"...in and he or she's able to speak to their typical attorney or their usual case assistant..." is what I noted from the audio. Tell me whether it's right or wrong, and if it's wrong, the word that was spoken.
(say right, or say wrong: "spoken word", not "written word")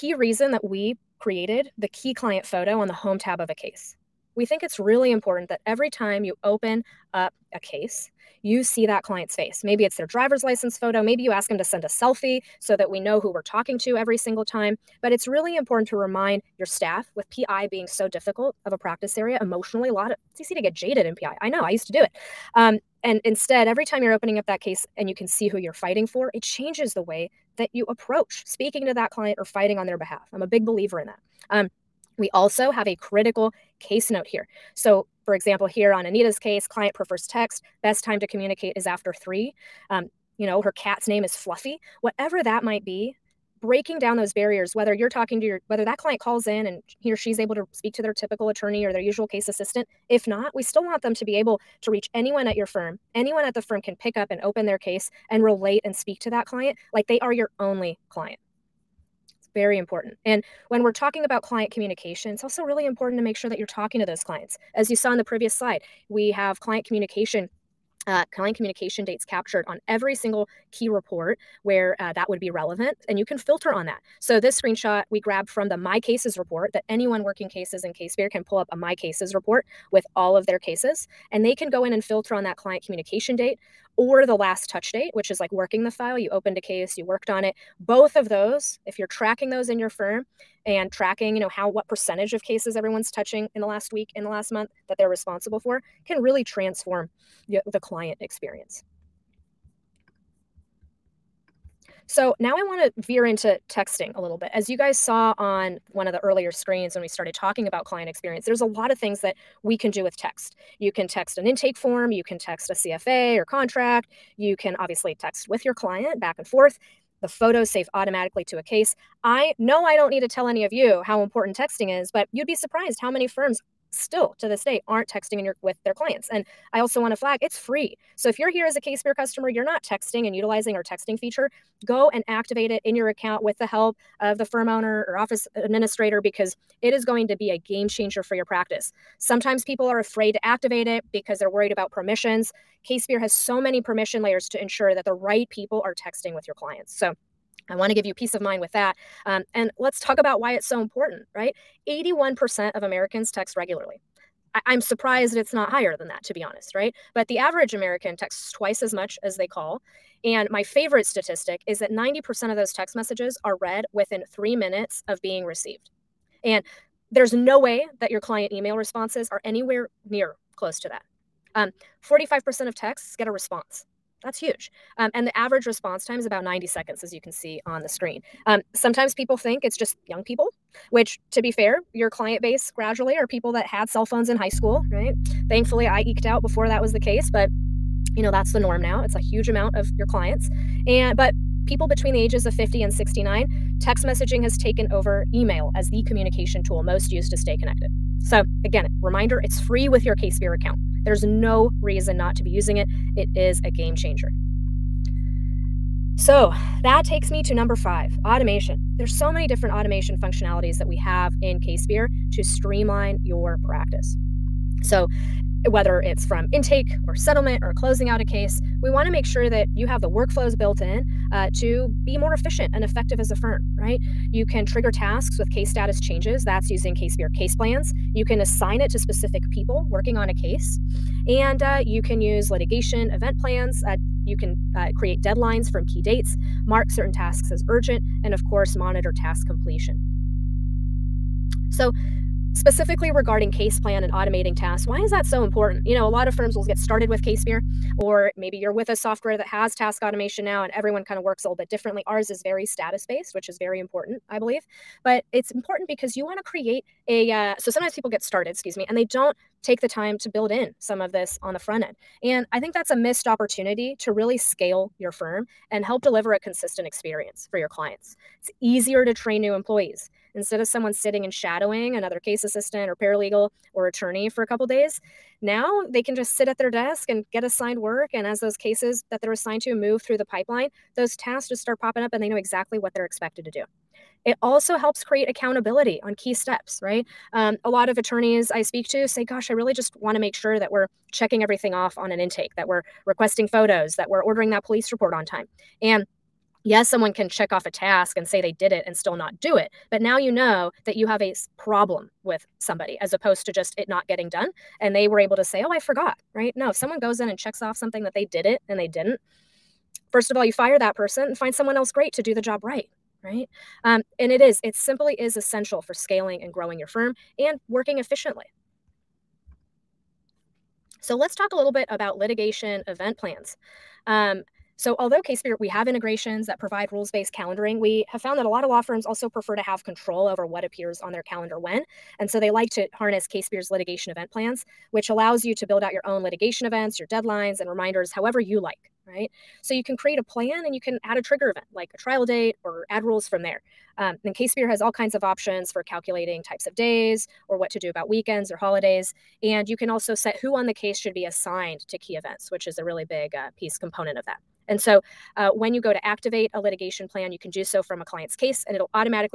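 right.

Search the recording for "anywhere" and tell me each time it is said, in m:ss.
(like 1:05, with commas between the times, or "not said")
2:49.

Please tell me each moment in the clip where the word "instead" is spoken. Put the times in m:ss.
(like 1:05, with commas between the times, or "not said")
0:23, 4:30.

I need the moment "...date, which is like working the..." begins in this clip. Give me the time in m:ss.
1:24.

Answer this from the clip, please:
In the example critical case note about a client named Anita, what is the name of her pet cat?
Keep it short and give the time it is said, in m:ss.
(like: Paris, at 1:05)
Fluffy, at 0:41.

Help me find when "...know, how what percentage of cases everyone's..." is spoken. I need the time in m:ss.
1:31.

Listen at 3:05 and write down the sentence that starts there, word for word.
Thankfully, I eked out before that was the case, but you know, that's the norm now.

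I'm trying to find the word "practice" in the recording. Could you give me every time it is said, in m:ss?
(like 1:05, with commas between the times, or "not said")
0:18, 2:18, 3:33.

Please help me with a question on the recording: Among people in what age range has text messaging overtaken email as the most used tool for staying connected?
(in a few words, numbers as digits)
50 to 69.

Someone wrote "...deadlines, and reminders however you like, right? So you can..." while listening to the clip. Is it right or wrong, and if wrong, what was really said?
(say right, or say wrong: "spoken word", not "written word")
right.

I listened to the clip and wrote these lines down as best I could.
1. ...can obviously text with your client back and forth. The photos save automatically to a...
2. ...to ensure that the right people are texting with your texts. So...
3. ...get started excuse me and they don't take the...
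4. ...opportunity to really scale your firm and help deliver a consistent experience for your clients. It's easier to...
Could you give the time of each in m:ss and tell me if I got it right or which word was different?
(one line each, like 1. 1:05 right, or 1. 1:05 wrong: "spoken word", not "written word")
1. 1:54 right
2. 2:24 wrong: "clients", not "texts"
3. 4:18 right
4. 4:23 right.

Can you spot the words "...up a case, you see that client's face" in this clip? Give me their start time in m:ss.
0:07.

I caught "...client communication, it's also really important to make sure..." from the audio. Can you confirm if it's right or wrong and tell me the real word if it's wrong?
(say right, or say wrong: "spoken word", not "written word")
right.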